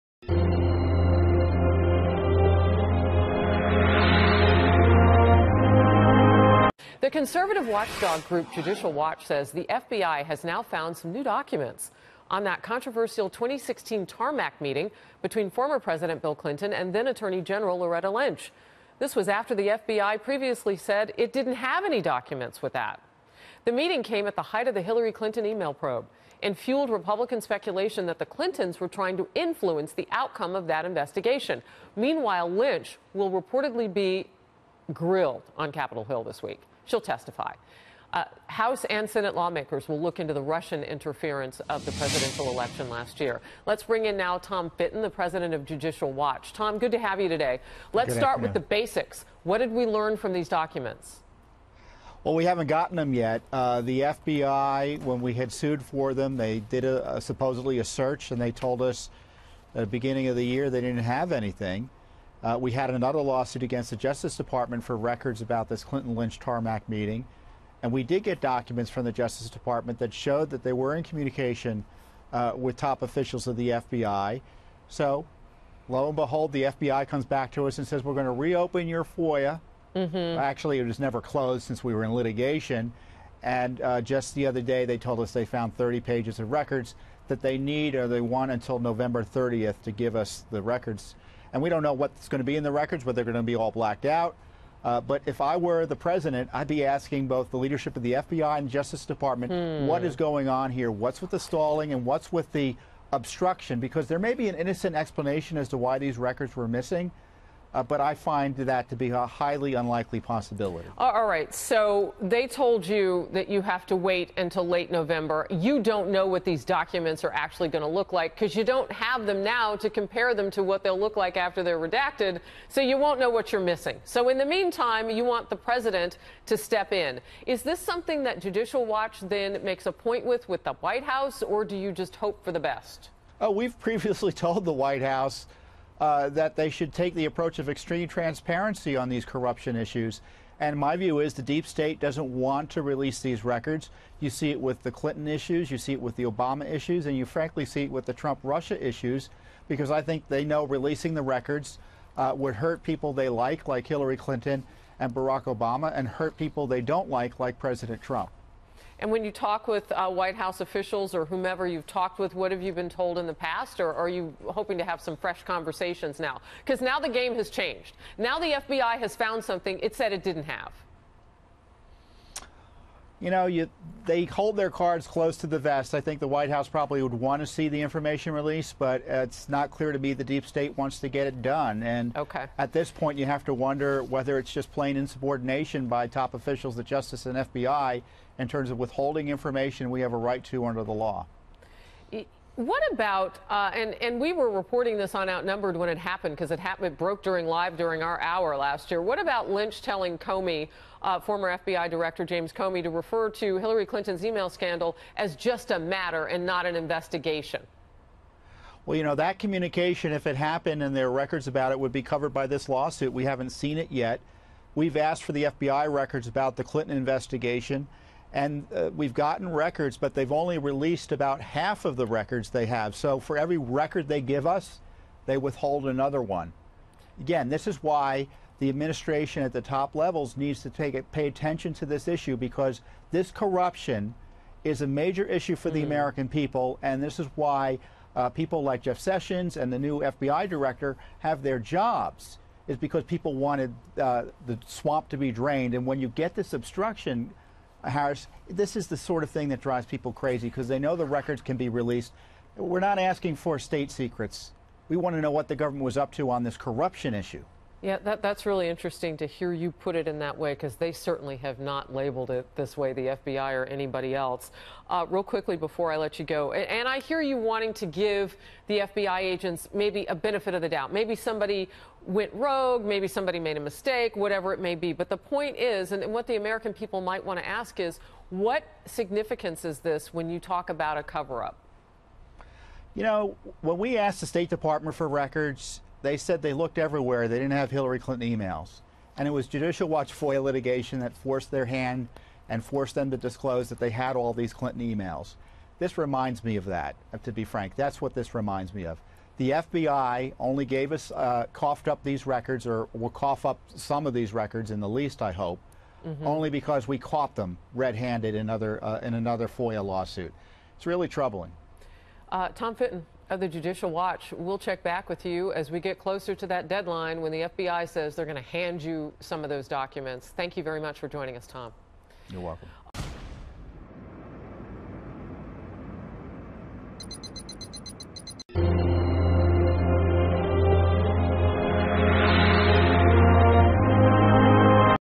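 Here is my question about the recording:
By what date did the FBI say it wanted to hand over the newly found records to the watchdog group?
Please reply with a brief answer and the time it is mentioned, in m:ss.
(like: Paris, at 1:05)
November 30th, at 1:28.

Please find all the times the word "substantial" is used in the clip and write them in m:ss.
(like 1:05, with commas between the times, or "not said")
not said.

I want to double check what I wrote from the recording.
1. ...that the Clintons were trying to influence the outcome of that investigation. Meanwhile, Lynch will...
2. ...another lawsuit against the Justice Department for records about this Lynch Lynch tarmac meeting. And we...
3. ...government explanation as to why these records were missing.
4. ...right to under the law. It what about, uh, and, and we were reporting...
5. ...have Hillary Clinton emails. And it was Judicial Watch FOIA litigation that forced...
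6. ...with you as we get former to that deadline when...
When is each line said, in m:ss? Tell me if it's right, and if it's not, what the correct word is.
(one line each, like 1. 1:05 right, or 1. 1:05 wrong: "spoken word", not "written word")
1. 0:28 right
2. 1:02 wrong: "Clinton", not "Lynch"
3. 1:44 wrong: "innocent", not "government"
4. 3:10 right
5. 4:47 right
6. 5:15 wrong: "closer", not "former".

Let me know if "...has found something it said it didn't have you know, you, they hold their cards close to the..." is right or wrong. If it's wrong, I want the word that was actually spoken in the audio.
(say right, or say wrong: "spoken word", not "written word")
right.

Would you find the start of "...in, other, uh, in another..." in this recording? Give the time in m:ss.
5:08.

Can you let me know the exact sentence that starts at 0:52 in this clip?
Well, we haven't gotten them yet.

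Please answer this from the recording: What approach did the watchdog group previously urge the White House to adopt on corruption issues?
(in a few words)
extreme transparency.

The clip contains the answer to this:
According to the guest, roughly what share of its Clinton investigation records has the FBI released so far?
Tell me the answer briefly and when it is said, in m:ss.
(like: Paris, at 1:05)
about half, at 3:41.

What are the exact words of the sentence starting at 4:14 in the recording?
We want to know what the government was up to on this corruption issue.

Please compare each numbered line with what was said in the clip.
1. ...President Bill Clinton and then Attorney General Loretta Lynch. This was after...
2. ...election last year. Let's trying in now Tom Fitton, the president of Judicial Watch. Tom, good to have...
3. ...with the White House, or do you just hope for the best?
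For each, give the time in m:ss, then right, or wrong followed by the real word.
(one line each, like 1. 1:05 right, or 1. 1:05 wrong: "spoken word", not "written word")
1. 0:15 right
2. 0:42 wrong: "bring", not "trying"
3. 2:10 right.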